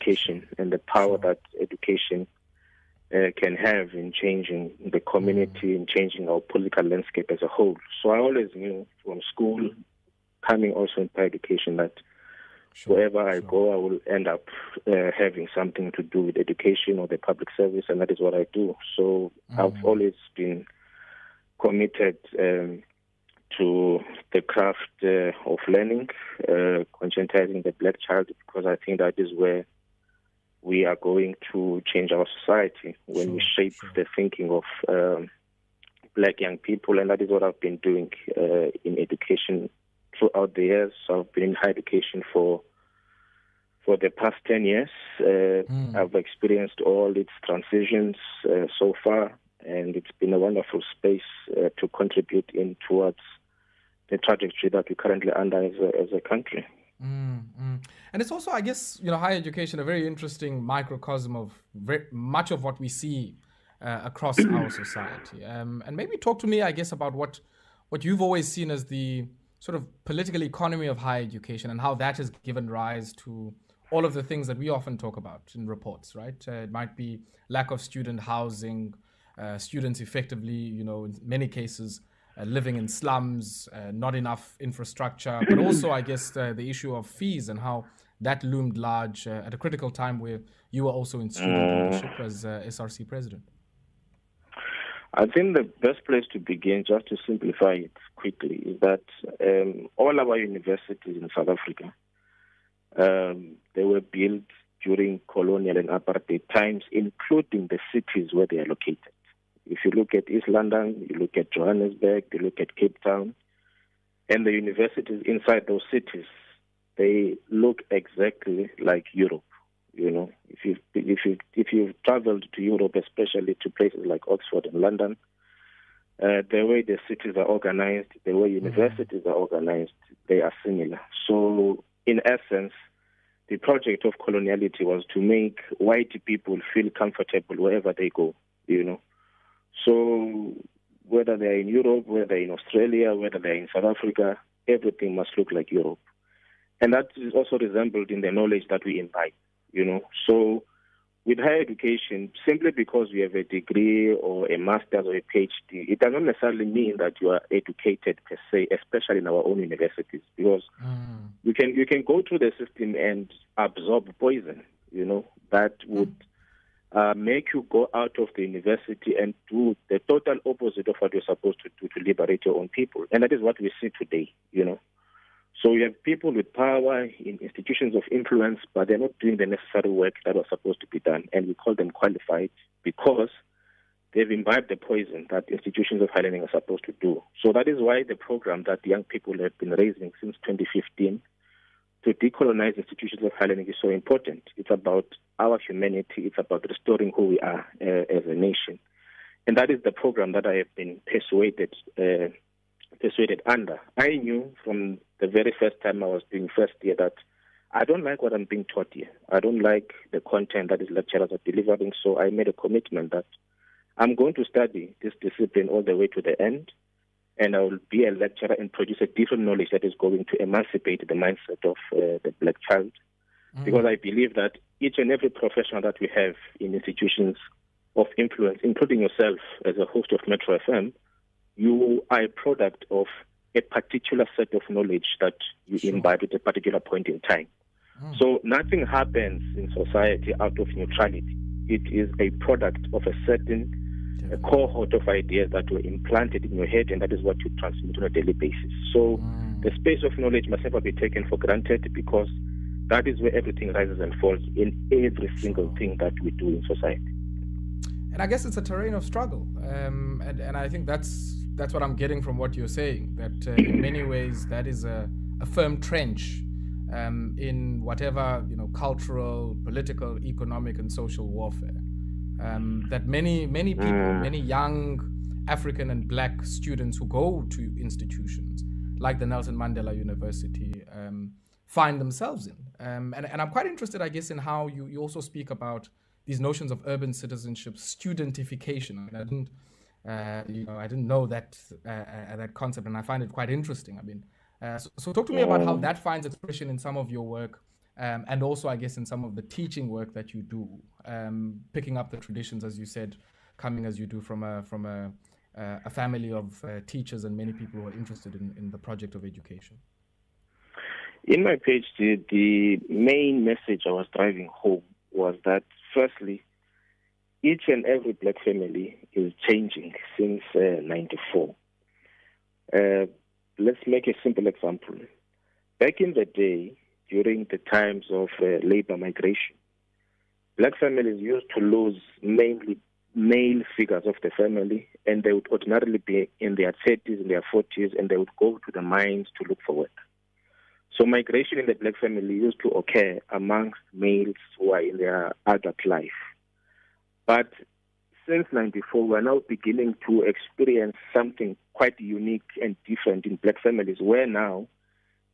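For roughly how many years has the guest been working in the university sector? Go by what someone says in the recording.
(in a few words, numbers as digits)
10 years.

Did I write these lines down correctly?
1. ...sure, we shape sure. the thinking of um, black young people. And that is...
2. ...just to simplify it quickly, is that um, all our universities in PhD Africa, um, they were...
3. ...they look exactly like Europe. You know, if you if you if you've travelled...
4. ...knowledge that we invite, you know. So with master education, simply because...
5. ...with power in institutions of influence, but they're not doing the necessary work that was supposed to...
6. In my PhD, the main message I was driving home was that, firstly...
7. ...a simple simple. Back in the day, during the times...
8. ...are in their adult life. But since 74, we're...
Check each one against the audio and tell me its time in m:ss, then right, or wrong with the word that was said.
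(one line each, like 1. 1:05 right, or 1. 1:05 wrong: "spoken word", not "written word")
1. 0:33 right
2. 1:36 wrong: "South", not "PhD"
3. 1:56 right
4. 2:28 wrong: "higher", not "master"
5. 2:56 right
6. 5:11 right
7. 5:24 wrong: "example", not "simple"
8. 5:44 wrong: "94", not "74".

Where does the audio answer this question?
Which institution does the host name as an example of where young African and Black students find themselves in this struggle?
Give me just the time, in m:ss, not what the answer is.
4:39.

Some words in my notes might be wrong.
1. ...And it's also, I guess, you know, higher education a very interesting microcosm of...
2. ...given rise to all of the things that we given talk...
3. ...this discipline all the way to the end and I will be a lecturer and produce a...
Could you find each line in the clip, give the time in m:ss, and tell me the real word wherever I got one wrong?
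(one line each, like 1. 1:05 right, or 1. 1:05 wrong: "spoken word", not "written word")
1. 0:58 right
2. 1:12 wrong: "often", not "given"
3. 3:35 right.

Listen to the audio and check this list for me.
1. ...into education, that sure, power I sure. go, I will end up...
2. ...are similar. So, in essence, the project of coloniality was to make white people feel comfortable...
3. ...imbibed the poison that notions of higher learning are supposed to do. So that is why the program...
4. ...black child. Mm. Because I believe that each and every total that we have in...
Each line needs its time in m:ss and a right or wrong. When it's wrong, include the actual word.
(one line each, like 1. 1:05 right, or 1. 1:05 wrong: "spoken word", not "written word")
1. 0:11 wrong: "wherever", not "power"
2. 2:10 right
3. 3:04 wrong: "institutions", not "notions"
4. 3:42 wrong: "professional", not "total".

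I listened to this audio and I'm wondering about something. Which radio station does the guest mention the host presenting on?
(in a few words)
Metro FM.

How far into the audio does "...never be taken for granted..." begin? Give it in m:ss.
4:10.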